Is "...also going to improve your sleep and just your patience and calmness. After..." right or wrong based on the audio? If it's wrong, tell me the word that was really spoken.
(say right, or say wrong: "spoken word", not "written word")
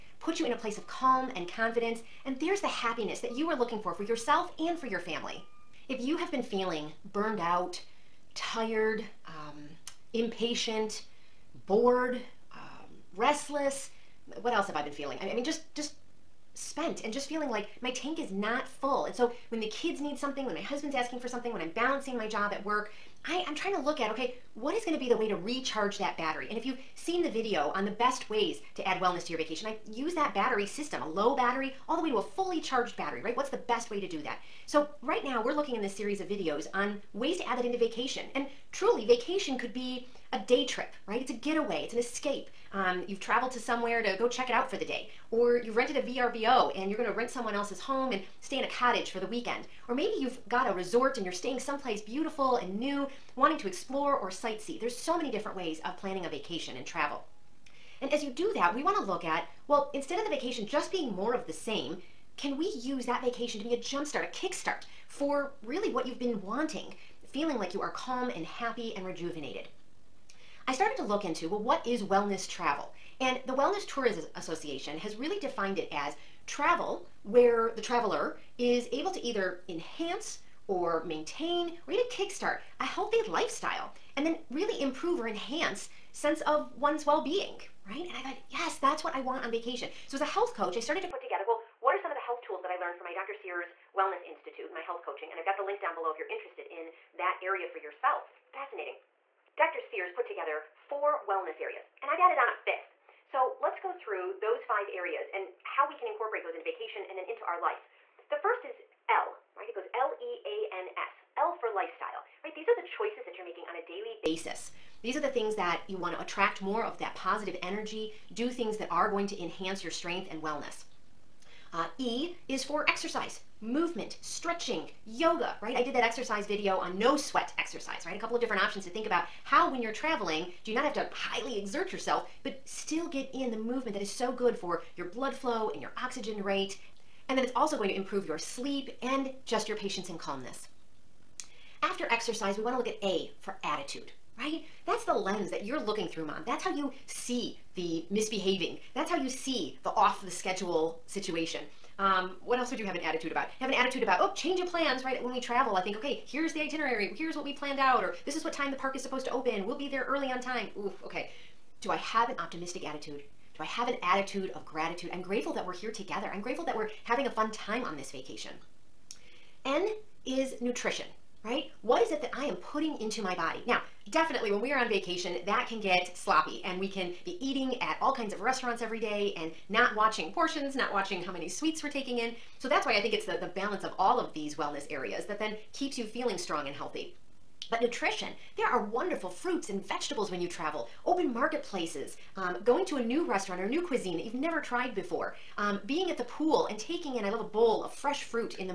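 right.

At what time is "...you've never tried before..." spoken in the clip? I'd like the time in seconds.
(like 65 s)
194 s.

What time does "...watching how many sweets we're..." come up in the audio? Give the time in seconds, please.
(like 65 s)
180 s.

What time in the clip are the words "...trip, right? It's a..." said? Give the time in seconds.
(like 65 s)
40 s.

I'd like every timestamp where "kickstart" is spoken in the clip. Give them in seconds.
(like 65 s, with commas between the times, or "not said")
64 s, 82 s.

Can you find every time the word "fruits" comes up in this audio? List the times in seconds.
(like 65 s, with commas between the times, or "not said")
189 s, 198 s.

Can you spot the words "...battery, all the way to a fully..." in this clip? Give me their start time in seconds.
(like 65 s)
31 s.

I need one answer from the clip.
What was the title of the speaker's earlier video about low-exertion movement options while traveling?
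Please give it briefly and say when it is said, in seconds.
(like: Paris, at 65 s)
No sweat exercise, at 126 s.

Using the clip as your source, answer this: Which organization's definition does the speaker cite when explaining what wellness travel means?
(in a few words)
Wellness Tourism Association.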